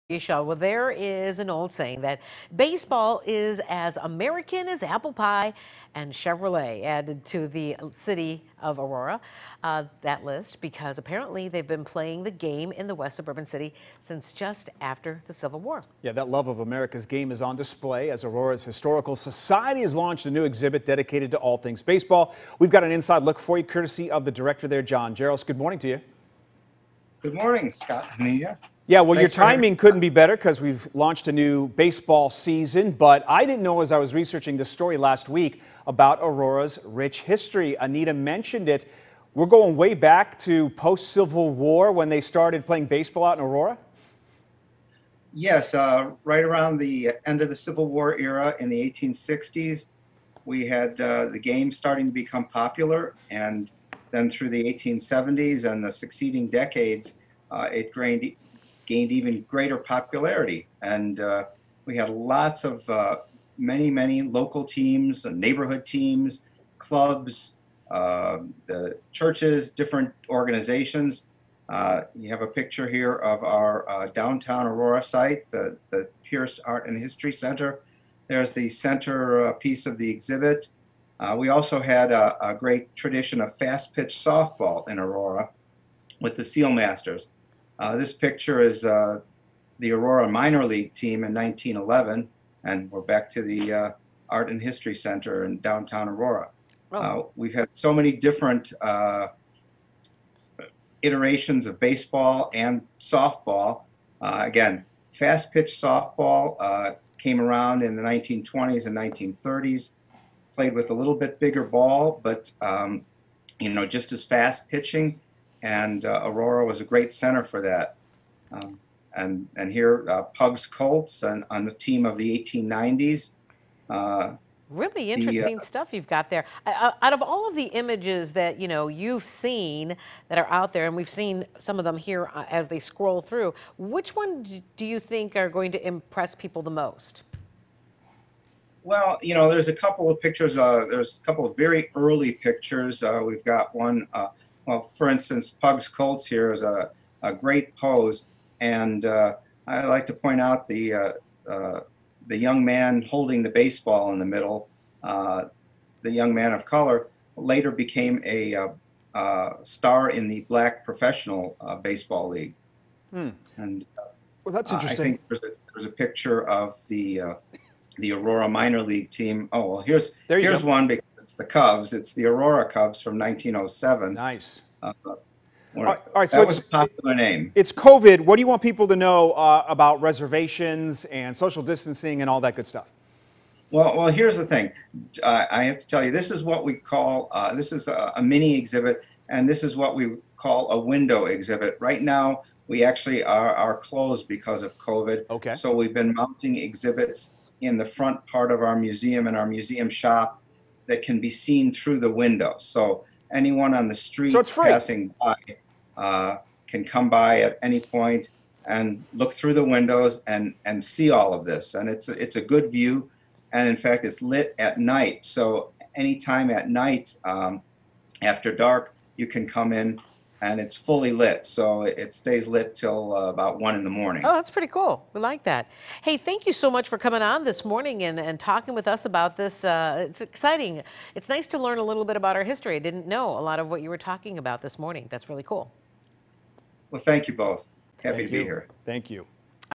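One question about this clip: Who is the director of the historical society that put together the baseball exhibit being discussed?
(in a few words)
John Jaros.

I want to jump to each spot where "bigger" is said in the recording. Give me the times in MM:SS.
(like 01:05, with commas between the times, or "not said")
01:51.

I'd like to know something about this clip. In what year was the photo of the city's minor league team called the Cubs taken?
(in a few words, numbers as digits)
1907.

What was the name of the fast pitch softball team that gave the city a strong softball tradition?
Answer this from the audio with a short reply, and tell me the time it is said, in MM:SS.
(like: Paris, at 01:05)
Seal Masters, at 01:26.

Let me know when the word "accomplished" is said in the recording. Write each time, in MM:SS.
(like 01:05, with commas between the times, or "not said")
not said.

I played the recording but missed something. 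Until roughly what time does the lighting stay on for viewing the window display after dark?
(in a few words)
1 in the morning.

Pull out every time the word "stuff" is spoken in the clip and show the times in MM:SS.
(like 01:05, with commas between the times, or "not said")
02:05, 03:02.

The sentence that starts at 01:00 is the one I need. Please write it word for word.
And uh, we had lots of uh, many, many local teams, uh, neighborhood teams, clubs, uh, churches, different organizations.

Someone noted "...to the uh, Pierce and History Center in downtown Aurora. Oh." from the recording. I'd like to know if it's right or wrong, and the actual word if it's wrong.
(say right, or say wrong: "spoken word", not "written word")
wrong: "Art", not "Pierce".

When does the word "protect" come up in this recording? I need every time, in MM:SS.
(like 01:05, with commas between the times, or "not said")
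not said.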